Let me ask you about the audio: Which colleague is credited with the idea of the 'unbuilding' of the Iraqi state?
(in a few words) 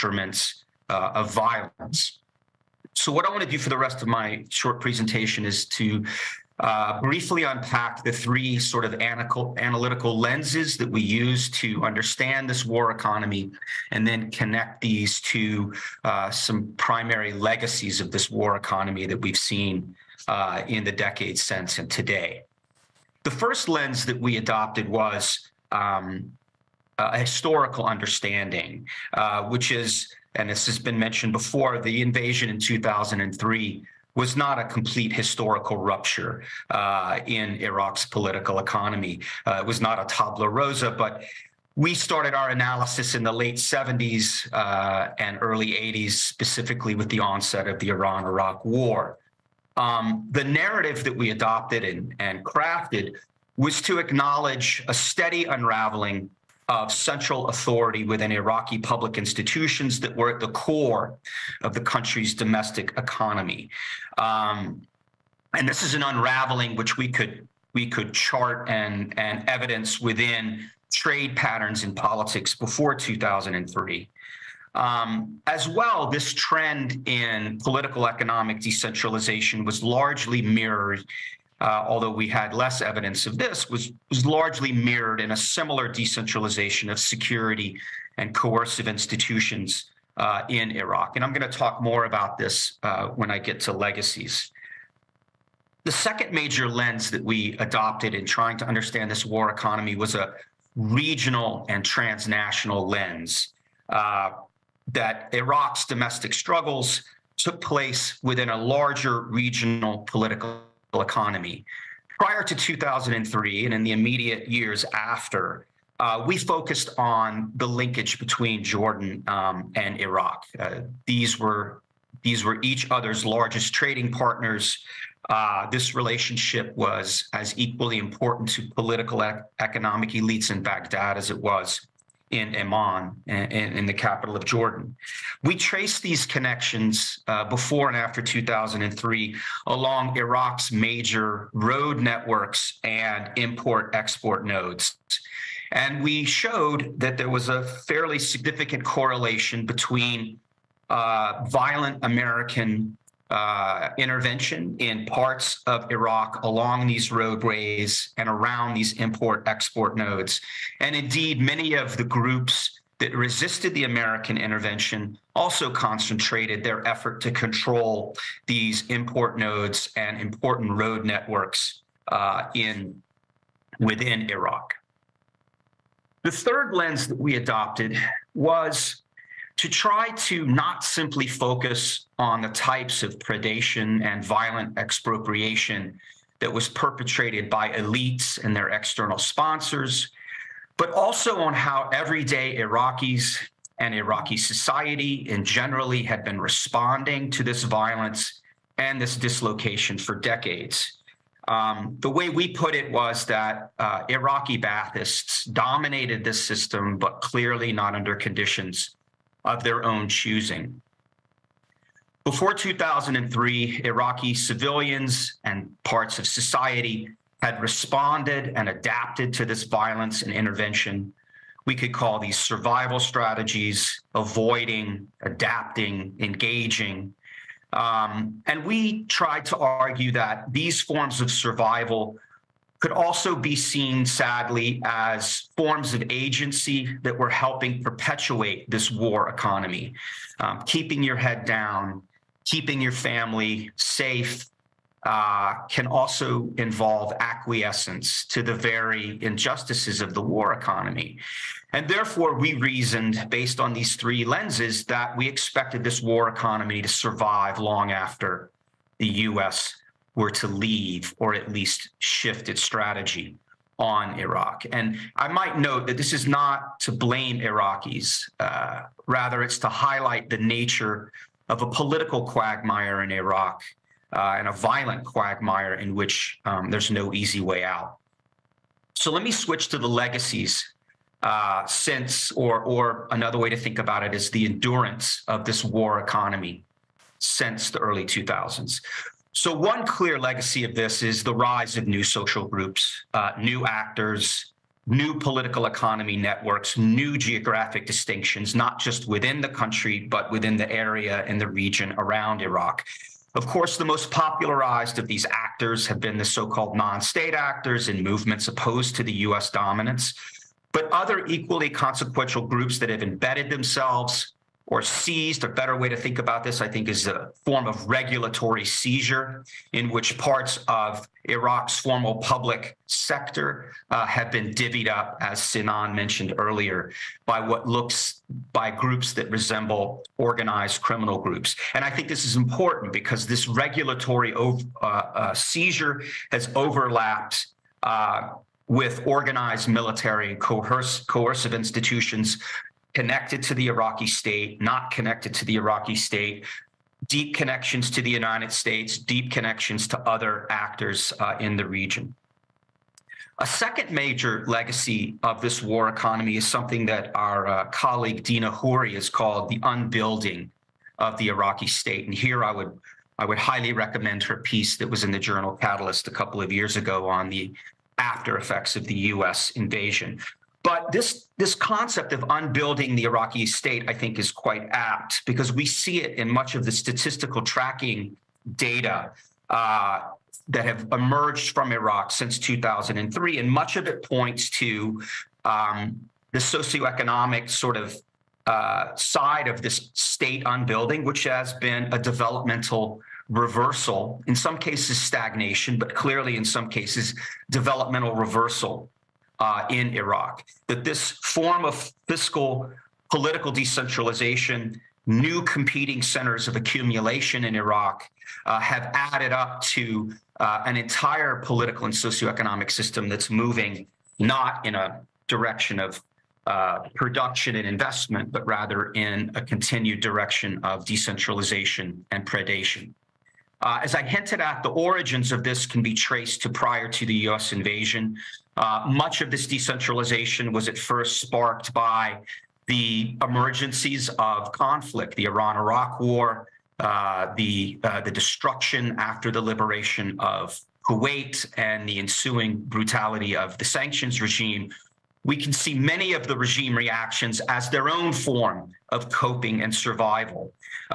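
Dina Khoury.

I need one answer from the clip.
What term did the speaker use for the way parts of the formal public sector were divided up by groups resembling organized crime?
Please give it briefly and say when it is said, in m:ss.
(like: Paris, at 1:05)
regulatory seizure, at 5:17.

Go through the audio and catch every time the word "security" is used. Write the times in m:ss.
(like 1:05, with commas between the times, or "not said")
1:26.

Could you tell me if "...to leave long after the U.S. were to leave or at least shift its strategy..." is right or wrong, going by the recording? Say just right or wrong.
wrong.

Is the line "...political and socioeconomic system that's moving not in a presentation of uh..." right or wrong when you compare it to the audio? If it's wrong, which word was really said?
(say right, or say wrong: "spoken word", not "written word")
wrong: "direction", not "presentation".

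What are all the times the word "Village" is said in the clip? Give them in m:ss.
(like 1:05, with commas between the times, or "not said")
not said.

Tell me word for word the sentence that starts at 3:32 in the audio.
Before 2003, Iraqi civilians and parts of society had responded and adapted to this violence and intervention.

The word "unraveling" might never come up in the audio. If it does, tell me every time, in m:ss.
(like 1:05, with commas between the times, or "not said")
0:55, 1:06.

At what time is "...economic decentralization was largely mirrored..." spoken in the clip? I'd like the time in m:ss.
1:18.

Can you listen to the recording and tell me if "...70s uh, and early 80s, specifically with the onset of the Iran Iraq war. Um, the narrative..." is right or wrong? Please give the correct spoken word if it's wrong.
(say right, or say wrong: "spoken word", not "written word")
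right.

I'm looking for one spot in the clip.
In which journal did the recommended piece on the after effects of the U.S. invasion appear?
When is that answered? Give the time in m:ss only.
6:05.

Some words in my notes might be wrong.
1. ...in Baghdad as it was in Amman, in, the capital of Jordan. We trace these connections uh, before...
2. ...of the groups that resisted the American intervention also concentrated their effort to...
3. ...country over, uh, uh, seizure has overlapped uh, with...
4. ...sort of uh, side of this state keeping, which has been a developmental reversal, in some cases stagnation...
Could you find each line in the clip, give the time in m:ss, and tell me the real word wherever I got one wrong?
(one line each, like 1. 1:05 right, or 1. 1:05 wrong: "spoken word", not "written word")
1. 2:10 right
2. 2:41 right
3. 5:33 wrong: "regulatory", not "country"
4. 6:27 wrong: "unbuilding", not "keeping".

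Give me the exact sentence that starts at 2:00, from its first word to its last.
Uh, these were these were each other's largest trading partners.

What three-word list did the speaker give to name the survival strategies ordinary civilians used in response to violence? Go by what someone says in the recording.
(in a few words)
avoiding, adapting, engaging.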